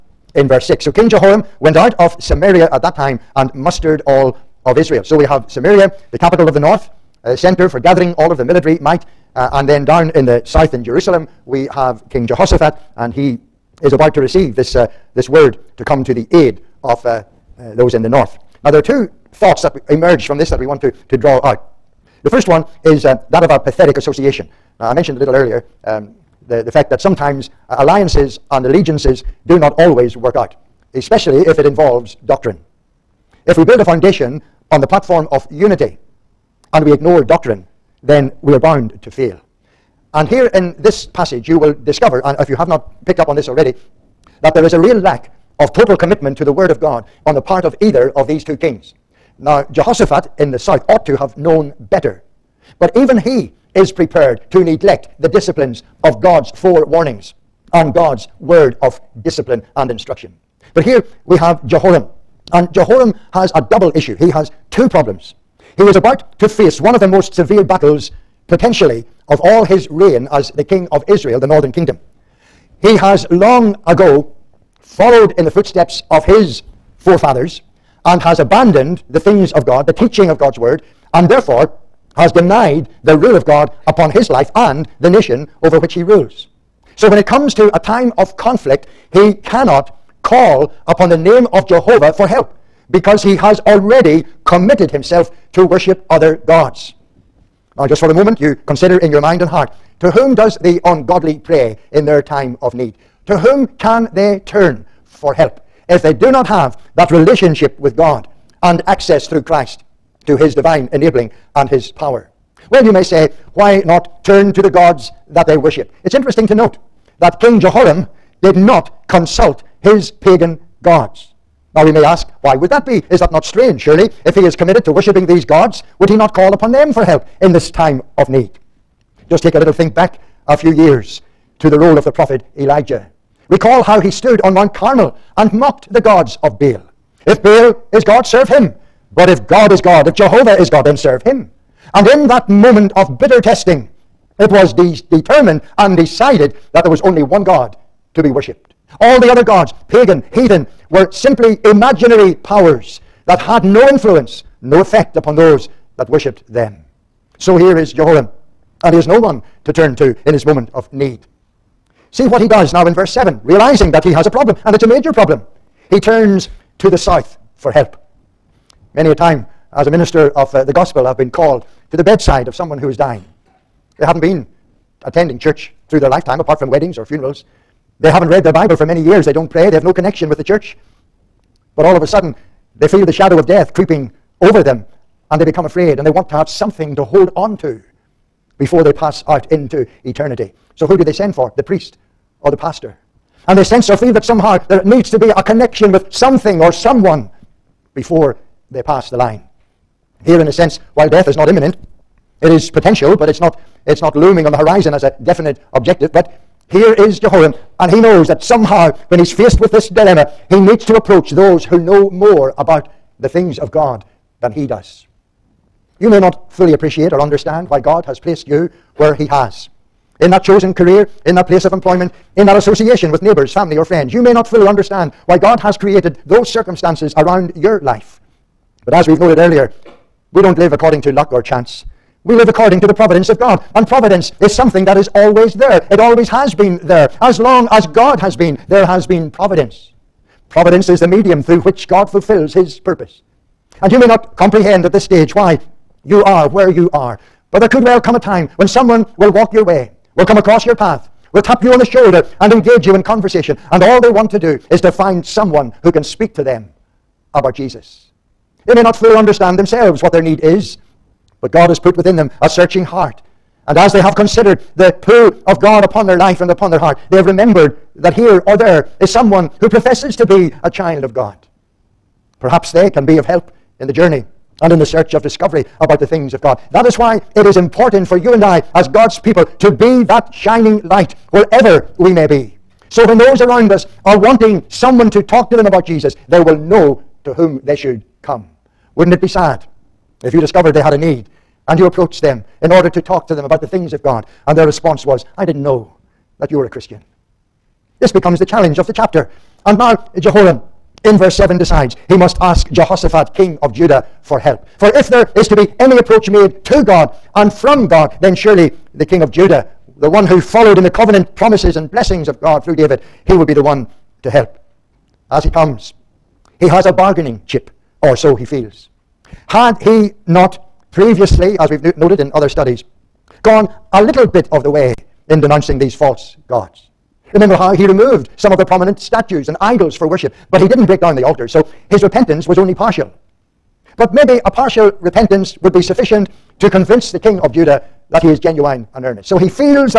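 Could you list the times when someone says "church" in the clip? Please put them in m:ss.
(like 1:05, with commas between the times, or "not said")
2:55, 3:00.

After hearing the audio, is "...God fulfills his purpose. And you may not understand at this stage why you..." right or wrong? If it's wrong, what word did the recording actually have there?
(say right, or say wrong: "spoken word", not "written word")
wrong: "comprehend", not "understand".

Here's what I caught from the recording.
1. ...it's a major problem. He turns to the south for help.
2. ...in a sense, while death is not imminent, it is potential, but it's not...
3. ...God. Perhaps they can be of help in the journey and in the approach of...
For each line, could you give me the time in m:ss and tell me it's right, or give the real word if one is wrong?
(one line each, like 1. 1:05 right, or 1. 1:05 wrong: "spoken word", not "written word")
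1. 2:44 right
2. 3:20 right
3. 4:31 wrong: "search", not "approach".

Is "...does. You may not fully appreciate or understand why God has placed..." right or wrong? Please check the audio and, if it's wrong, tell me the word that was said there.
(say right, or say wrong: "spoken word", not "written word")
right.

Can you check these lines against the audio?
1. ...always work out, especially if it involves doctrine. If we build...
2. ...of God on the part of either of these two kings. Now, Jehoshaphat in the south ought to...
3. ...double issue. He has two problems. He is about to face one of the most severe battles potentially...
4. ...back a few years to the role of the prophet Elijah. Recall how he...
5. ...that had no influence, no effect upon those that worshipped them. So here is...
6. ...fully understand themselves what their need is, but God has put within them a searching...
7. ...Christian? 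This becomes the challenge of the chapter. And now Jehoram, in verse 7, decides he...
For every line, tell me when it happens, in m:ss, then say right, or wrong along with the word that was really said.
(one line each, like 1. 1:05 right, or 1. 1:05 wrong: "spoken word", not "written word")
1. 0:29 right
2. 0:46 right
3. 1:03 right
4. 2:09 right
5. 2:33 right
6. 4:18 right
7. 4:56 right.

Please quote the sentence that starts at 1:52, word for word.
Well, you may say, why not turn to the gods that they worship?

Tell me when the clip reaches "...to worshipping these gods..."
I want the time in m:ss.
2:04.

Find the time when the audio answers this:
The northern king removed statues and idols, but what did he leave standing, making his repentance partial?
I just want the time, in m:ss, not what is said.
5:31.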